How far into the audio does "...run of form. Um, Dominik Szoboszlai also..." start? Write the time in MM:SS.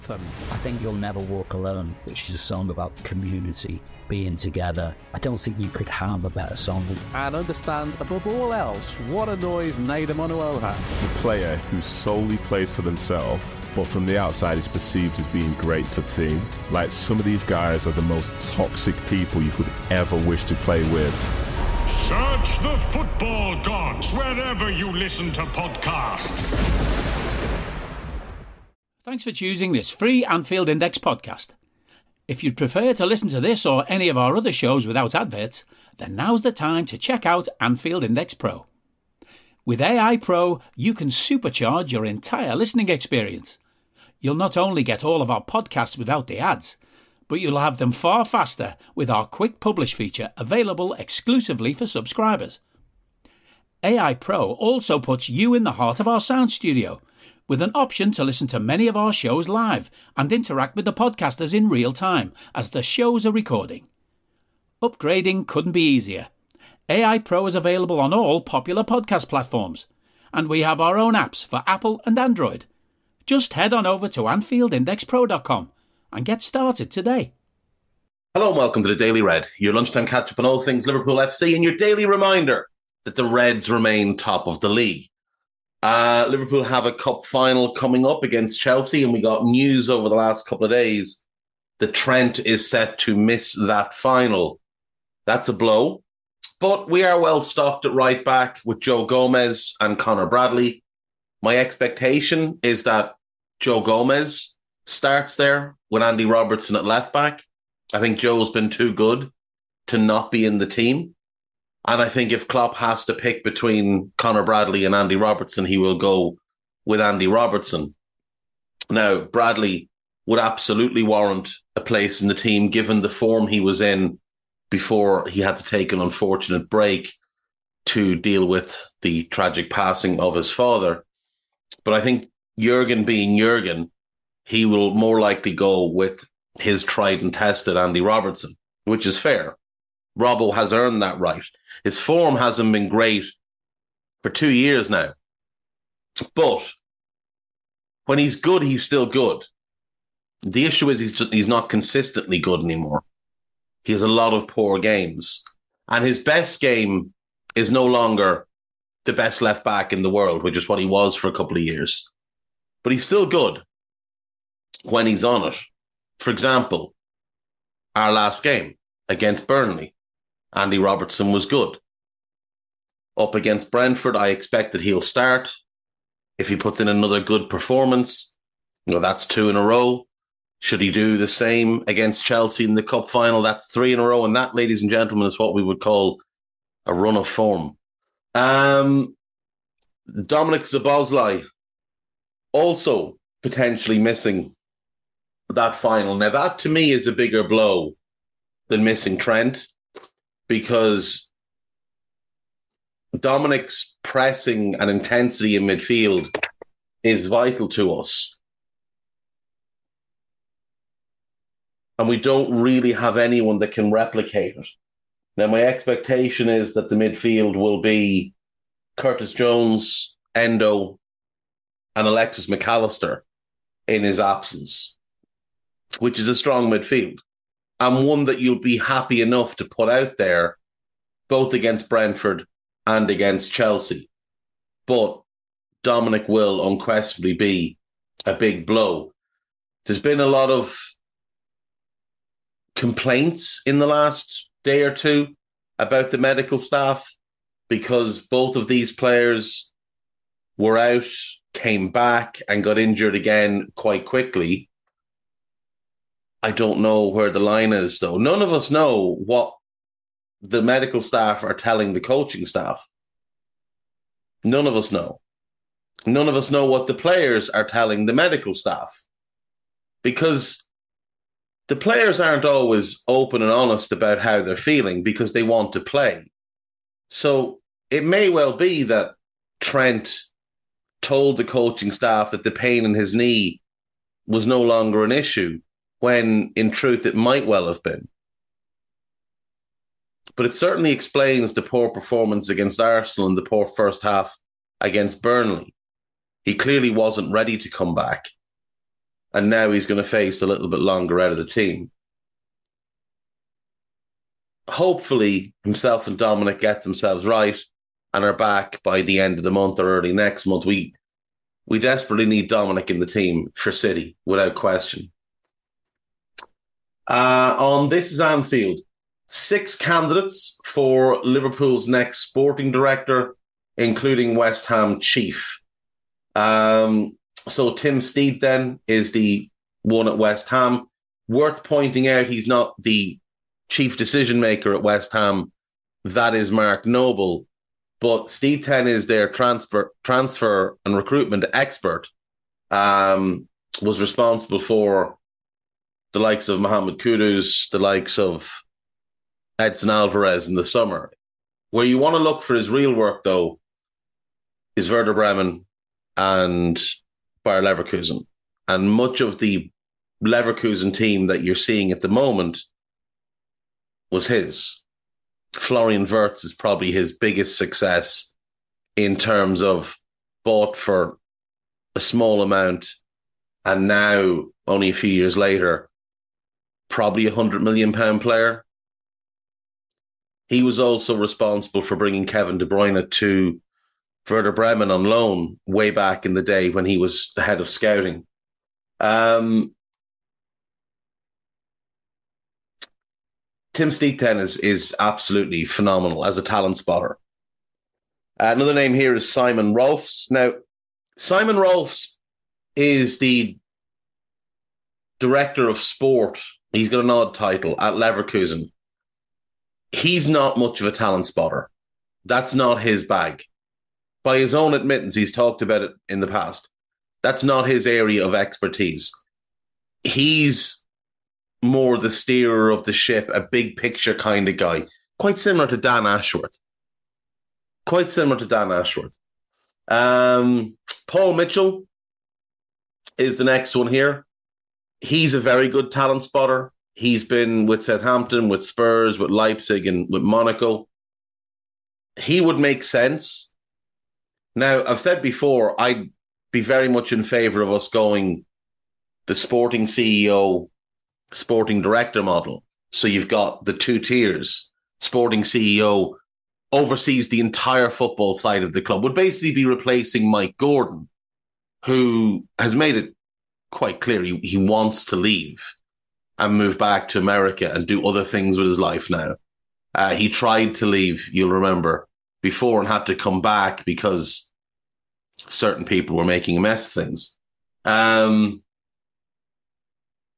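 03:06.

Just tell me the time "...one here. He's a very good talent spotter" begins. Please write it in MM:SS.
07:13.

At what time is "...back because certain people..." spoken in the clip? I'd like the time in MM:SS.
07:53.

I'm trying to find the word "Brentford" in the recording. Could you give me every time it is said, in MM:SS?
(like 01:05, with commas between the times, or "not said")
02:53, 03:51.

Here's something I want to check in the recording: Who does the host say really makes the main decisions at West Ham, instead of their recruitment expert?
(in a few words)
Mark Noble.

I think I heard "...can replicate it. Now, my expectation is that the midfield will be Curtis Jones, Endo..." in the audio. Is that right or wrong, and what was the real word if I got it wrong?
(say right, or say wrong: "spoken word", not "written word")
right.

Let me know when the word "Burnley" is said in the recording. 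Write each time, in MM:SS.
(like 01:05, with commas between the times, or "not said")
02:49, 04:55.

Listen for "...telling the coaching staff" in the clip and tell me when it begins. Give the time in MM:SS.
04:21.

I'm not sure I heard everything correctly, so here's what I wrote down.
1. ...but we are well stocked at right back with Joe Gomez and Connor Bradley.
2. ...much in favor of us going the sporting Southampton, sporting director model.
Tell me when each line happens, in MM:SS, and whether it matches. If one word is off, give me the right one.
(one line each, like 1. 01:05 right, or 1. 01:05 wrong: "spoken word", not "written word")
1. 01:36 right
2. 07:26 wrong: "CEO", not "Southampton".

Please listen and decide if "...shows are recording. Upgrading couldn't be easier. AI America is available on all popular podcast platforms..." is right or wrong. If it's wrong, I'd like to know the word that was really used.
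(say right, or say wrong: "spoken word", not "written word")
wrong: "Pro", not "America".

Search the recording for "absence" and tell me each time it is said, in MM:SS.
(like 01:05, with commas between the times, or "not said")
03:44.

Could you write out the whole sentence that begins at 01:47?
I think Joe's been too good to not be in the team.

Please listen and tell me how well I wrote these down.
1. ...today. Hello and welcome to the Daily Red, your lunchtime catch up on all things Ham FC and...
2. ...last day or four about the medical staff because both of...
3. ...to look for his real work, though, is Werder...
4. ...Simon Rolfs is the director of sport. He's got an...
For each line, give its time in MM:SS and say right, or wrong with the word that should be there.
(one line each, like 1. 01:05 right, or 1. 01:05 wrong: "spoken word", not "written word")
1. 01:16 wrong: "Liverpool", not "Ham"
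2. 04:03 wrong: "two", not "four"
3. 05:52 right
4. 06:41 right.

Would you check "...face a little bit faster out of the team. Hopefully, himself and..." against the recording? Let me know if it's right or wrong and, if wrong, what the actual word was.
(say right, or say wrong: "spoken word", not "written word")
wrong: "longer", not "faster".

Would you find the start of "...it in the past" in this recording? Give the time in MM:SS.
06:55.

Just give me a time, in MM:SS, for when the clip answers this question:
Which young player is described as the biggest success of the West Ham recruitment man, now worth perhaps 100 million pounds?
06:05.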